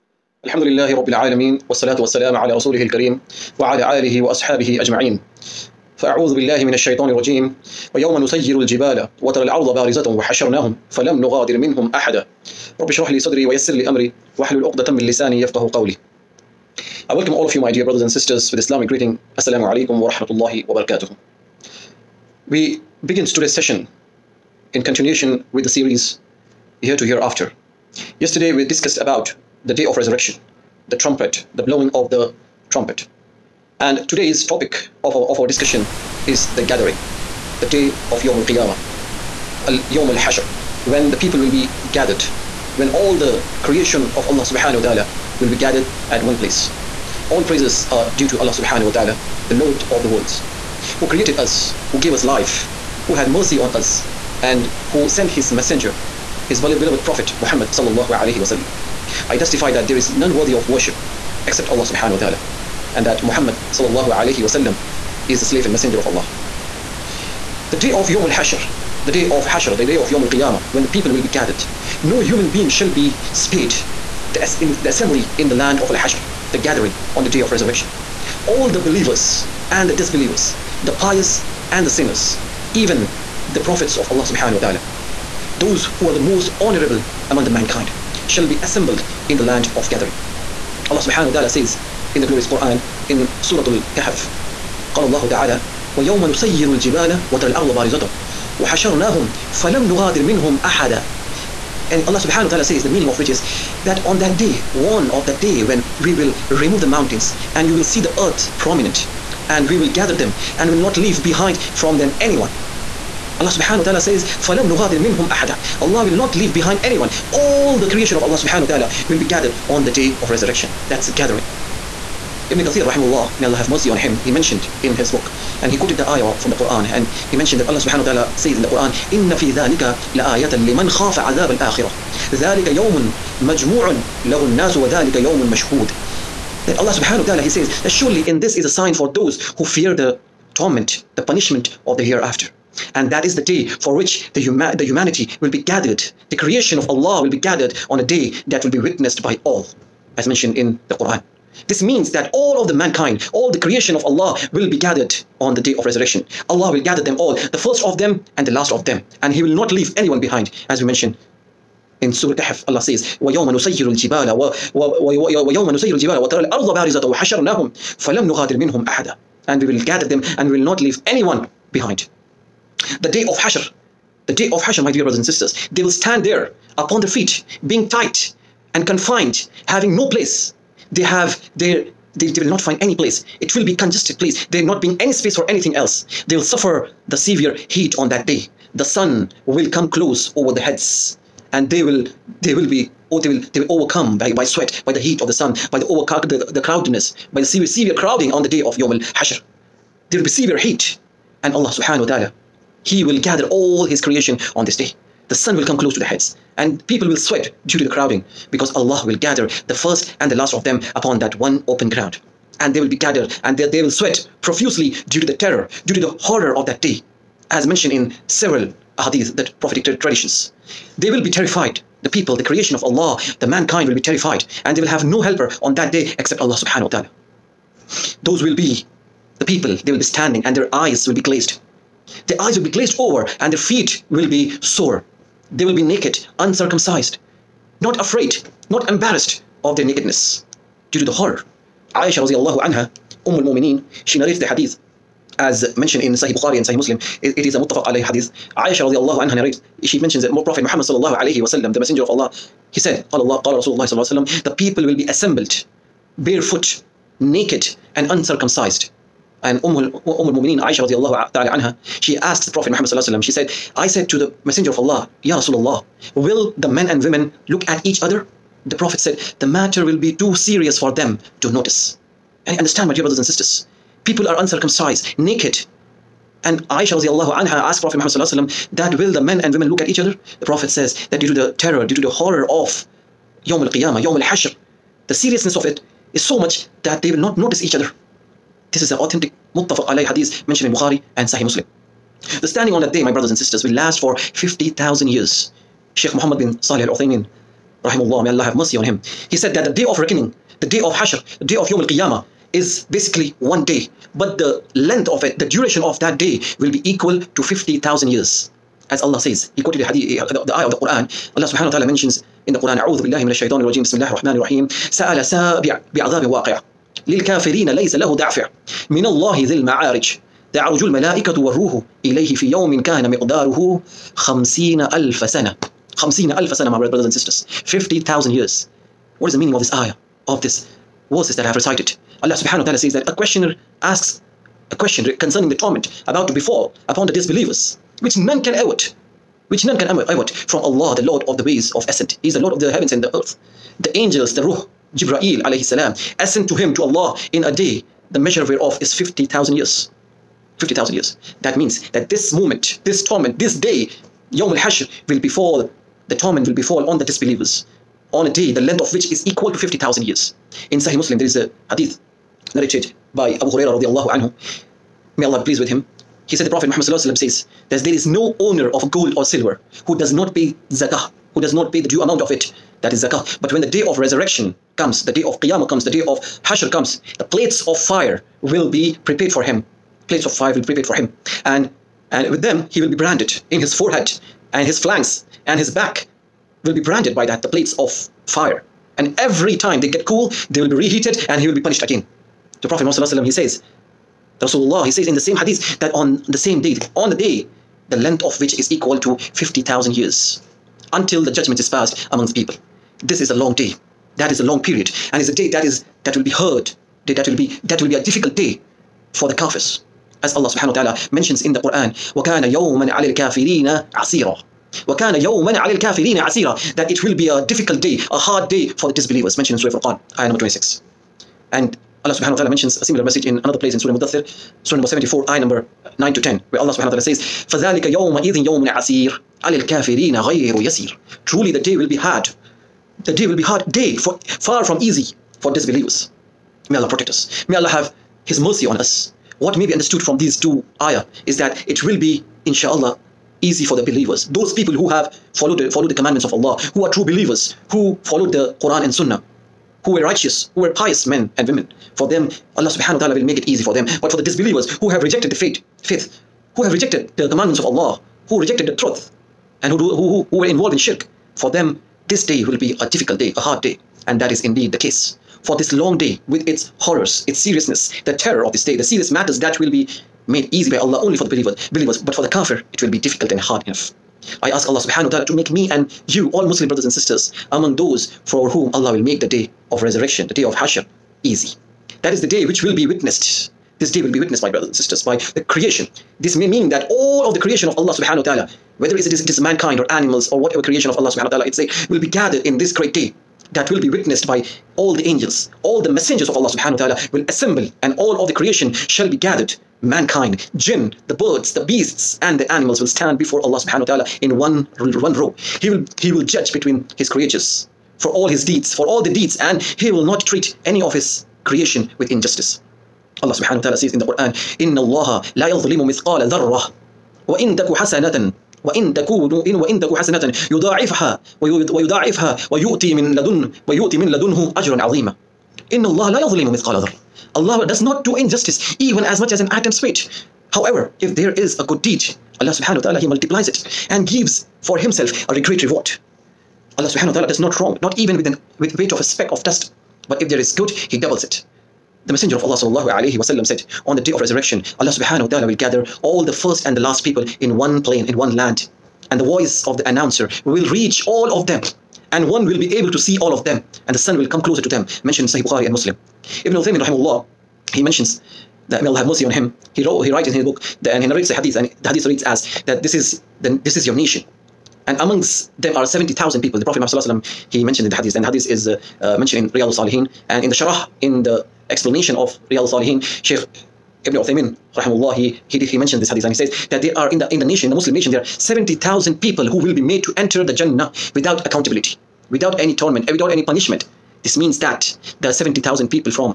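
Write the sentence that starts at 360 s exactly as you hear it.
In Sahih Muslim, there is a hadith narrated by Abu Hurairah radiallahu anhu.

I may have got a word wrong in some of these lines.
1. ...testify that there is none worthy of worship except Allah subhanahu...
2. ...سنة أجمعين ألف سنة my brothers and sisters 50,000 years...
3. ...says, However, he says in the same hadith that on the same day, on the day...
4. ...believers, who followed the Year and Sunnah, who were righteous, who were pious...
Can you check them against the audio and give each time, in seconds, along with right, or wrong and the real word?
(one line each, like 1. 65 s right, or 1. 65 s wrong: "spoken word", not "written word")
1. 59 s right
2. 325 s wrong: "خمسين", not "أجمعين"
3. 393 s wrong: "Rasulullah", not "However"
4. 447 s wrong: "Quran", not "Year".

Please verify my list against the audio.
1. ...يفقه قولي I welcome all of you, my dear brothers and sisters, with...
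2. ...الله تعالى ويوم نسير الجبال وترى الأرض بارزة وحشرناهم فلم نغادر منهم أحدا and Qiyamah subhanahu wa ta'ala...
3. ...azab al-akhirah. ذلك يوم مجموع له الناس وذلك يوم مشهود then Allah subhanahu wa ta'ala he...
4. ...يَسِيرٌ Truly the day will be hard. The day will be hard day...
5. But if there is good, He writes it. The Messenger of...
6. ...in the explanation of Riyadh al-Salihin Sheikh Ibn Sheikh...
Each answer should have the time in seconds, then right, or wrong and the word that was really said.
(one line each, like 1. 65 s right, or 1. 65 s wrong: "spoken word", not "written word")
1. 15 s right
2. 95 s wrong: "Allah", not "Qiyamah"
3. 131 s right
4. 430 s right
5. 540 s wrong: "doubles", not "writes"
6. 571 s wrong: "Uthaymin", not "Sheikh".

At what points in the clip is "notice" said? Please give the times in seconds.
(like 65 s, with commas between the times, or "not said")
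271 s, 287 s.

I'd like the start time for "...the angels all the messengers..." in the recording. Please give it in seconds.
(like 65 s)
494 s.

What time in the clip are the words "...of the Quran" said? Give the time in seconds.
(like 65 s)
310 s.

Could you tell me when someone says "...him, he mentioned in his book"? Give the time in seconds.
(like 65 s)
123 s.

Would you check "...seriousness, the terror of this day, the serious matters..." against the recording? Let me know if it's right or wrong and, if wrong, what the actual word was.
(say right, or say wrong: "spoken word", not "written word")
right.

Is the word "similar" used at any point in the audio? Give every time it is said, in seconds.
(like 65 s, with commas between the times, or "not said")
422 s.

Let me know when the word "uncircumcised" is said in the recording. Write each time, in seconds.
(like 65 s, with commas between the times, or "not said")
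236 s, 258 s, 274 s.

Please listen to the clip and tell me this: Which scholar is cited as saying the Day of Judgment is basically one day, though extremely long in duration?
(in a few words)
Muhammad bin Salih al Uthaymin.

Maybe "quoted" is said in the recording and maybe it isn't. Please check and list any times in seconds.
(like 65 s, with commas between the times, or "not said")
125 s, 309 s.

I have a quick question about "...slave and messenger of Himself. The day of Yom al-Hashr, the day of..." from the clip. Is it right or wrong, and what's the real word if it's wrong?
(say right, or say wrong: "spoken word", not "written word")
wrong: "Allah", not "Himself".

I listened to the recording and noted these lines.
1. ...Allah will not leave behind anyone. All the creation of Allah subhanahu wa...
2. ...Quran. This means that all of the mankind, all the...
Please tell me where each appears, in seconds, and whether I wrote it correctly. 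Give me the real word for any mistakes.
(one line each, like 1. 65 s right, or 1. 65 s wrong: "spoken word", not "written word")
1. 115 s right
2. 150 s right.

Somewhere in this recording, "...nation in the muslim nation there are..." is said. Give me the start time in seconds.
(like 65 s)
577 s.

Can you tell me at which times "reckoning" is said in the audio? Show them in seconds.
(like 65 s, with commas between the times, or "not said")
299 s.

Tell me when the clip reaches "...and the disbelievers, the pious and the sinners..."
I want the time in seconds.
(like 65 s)
79 s.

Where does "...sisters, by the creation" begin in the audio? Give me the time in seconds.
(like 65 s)
484 s.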